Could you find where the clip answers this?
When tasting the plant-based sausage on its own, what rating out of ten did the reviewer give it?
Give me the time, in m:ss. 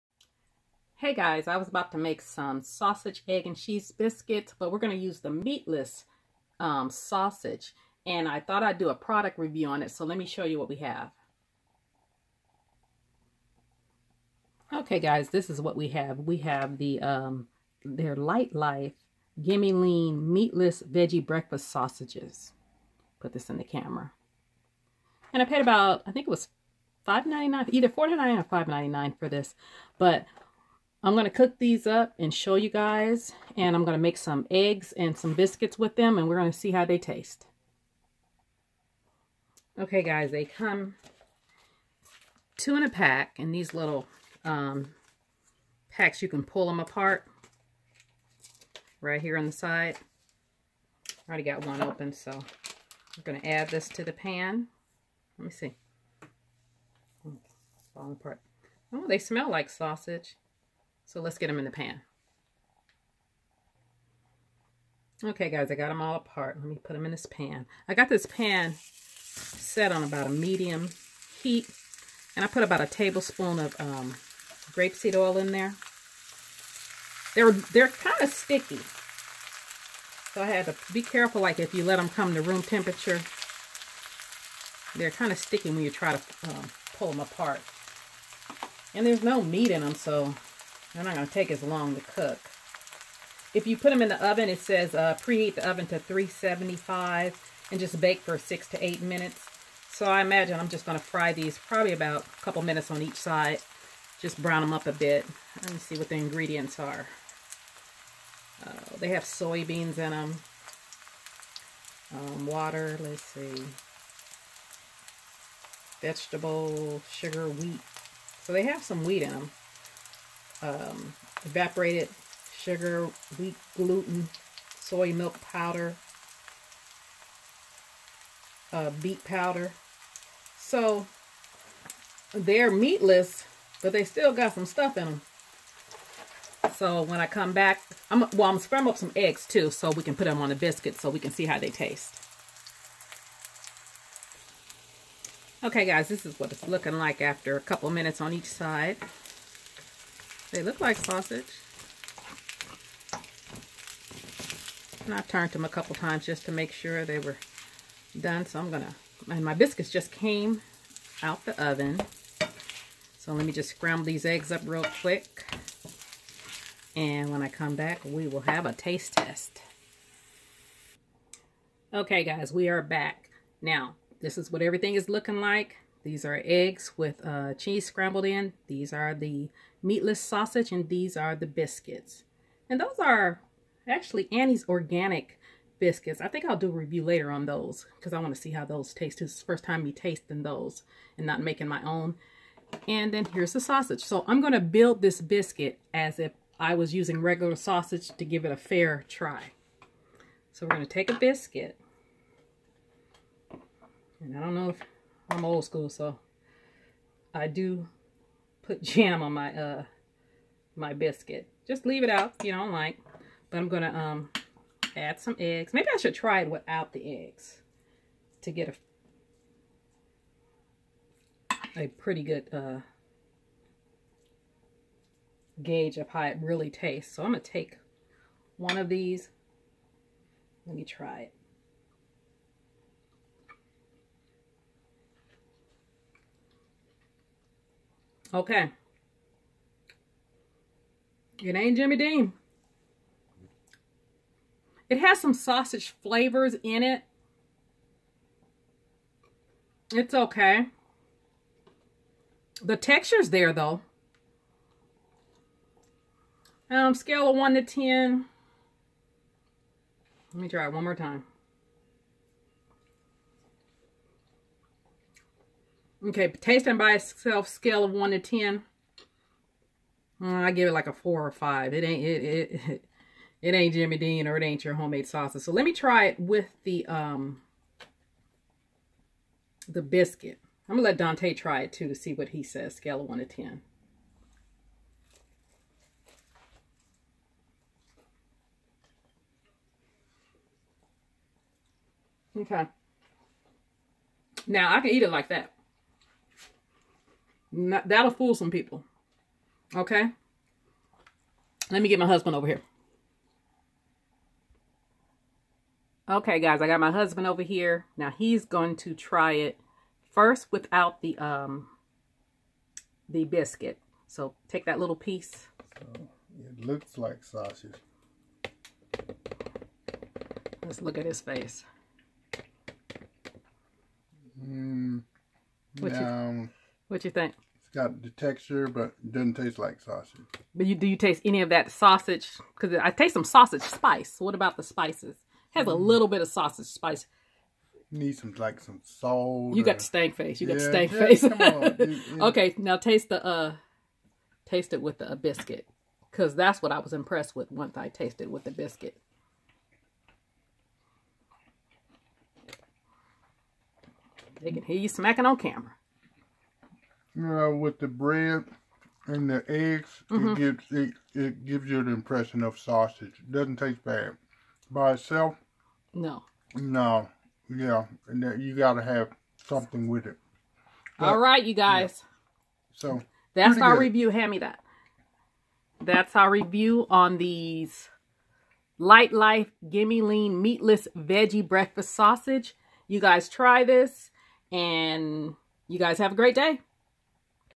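4:30.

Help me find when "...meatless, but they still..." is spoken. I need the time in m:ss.
2:12.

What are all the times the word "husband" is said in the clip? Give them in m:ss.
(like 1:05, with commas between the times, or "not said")
5:02, 5:06.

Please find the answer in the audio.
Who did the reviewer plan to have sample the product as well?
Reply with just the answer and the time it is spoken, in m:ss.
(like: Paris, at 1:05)
Dante, at 4:40.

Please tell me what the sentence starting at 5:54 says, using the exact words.
They can hear you smacking on camera with the bread and the eggs, mm-hmm.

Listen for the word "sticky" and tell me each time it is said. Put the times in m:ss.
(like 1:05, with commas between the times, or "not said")
1:18, 1:25.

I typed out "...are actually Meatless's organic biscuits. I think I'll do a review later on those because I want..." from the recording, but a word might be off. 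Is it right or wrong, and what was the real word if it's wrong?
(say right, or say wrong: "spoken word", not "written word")
wrong: "Annie", not "Meatless".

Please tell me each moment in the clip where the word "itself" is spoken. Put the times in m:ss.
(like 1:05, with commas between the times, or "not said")
4:26, 6:04.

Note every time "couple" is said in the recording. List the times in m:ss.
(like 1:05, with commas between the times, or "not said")
1:42, 2:27, 2:35.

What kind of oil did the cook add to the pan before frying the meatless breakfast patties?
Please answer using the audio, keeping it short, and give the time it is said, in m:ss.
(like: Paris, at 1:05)
grapeseed oil, at 1:14.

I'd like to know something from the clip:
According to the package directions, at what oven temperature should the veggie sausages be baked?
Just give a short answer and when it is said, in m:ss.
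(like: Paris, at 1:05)
375, at 1:35.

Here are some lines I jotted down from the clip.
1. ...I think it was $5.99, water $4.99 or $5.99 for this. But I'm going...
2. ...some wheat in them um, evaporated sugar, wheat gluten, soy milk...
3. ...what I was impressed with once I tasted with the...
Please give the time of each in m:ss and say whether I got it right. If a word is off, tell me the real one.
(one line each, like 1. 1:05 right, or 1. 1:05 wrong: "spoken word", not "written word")
1. 0:26 wrong: "either", not "water"
2. 1:58 right
3. 5:46 right.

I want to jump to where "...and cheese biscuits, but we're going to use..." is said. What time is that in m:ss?
0:03.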